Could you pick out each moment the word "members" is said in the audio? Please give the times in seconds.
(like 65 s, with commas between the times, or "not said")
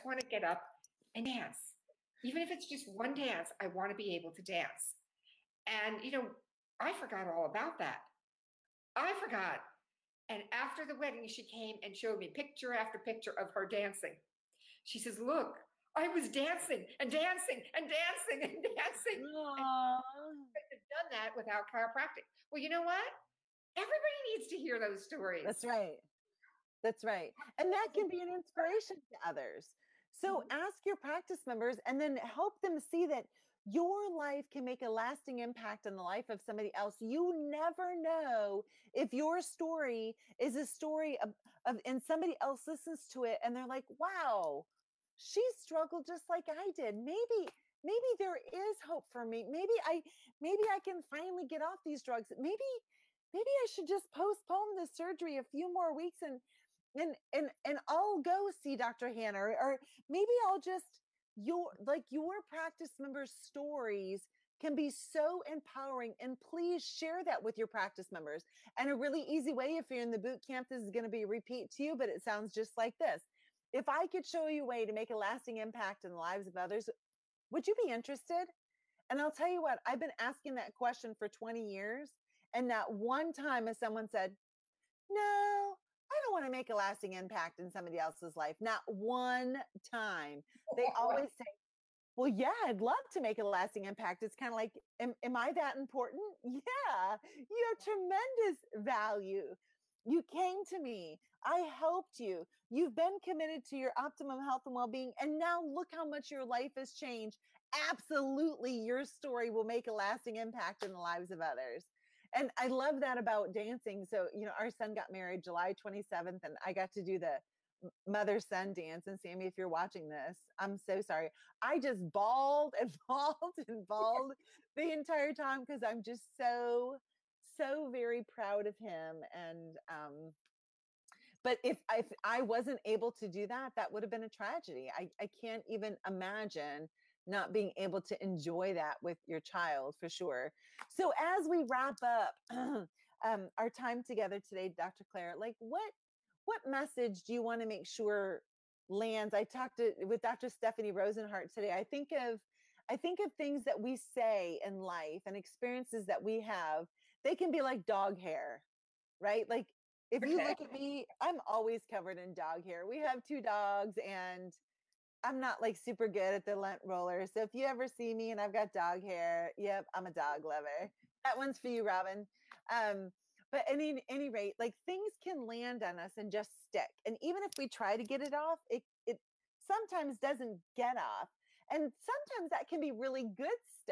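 31 s, 62 s, 68 s.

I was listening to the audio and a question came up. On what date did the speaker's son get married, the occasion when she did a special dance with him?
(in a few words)
July 27th.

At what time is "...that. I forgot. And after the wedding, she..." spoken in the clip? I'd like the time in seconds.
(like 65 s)
7 s.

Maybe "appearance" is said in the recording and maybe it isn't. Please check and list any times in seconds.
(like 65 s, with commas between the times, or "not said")
not said.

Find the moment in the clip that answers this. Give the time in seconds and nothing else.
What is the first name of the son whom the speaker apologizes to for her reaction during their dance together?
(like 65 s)
119 s.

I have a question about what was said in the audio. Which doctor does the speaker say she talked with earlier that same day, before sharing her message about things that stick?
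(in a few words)
Dr. Stephanie Rosenhart.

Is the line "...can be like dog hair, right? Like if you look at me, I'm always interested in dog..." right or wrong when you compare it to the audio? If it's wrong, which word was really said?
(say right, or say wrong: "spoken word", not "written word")
wrong: "covered", not "interested".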